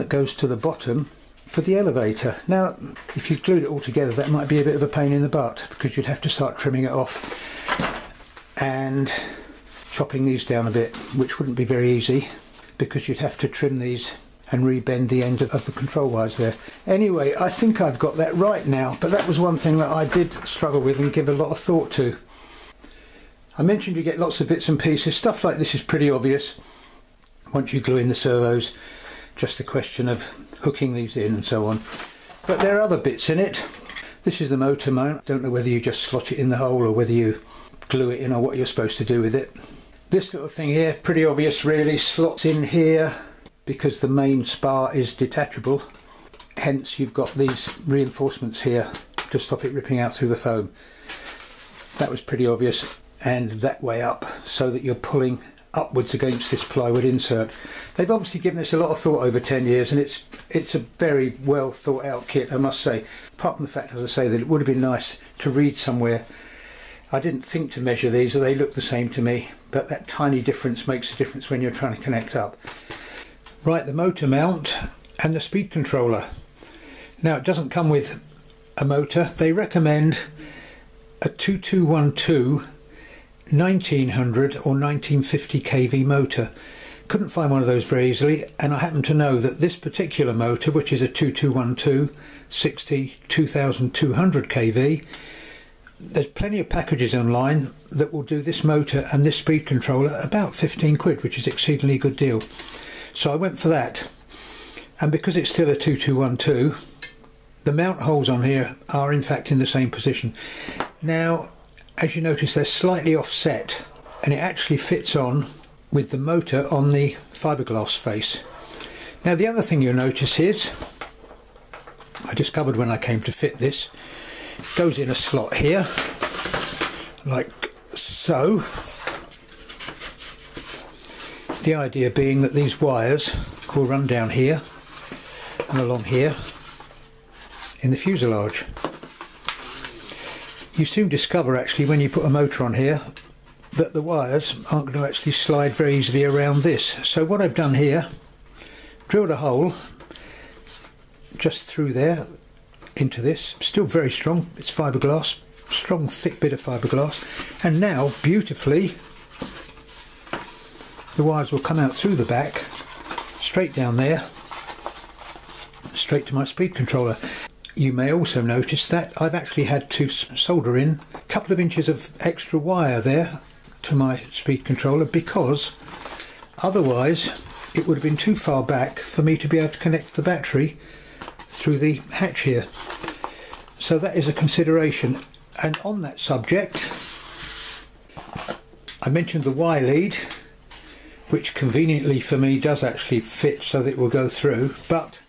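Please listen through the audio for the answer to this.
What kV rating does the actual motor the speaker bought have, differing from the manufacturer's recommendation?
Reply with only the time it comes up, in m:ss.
1:33.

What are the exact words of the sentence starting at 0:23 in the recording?
I mentioned you get lots of bits and pieces.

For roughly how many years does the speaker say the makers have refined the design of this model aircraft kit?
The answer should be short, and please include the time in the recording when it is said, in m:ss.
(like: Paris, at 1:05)
10 years, at 0:59.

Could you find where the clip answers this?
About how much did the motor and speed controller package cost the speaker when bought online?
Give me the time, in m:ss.
1:40.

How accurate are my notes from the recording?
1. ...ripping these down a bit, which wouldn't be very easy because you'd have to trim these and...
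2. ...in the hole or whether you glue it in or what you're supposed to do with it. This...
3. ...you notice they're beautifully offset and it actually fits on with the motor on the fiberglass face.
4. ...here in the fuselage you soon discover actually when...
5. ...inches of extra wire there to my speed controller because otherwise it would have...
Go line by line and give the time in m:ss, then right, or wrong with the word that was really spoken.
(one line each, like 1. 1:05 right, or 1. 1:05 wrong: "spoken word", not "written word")
1. 0:09 wrong: "chopping", not "ripping"
2. 0:36 right
3. 1:52 wrong: "slightly", not "beautifully"
4. 2:16 right
5. 2:51 right.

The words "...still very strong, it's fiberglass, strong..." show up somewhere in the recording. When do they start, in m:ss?
2:33.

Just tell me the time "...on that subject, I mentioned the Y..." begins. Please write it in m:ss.
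3:05.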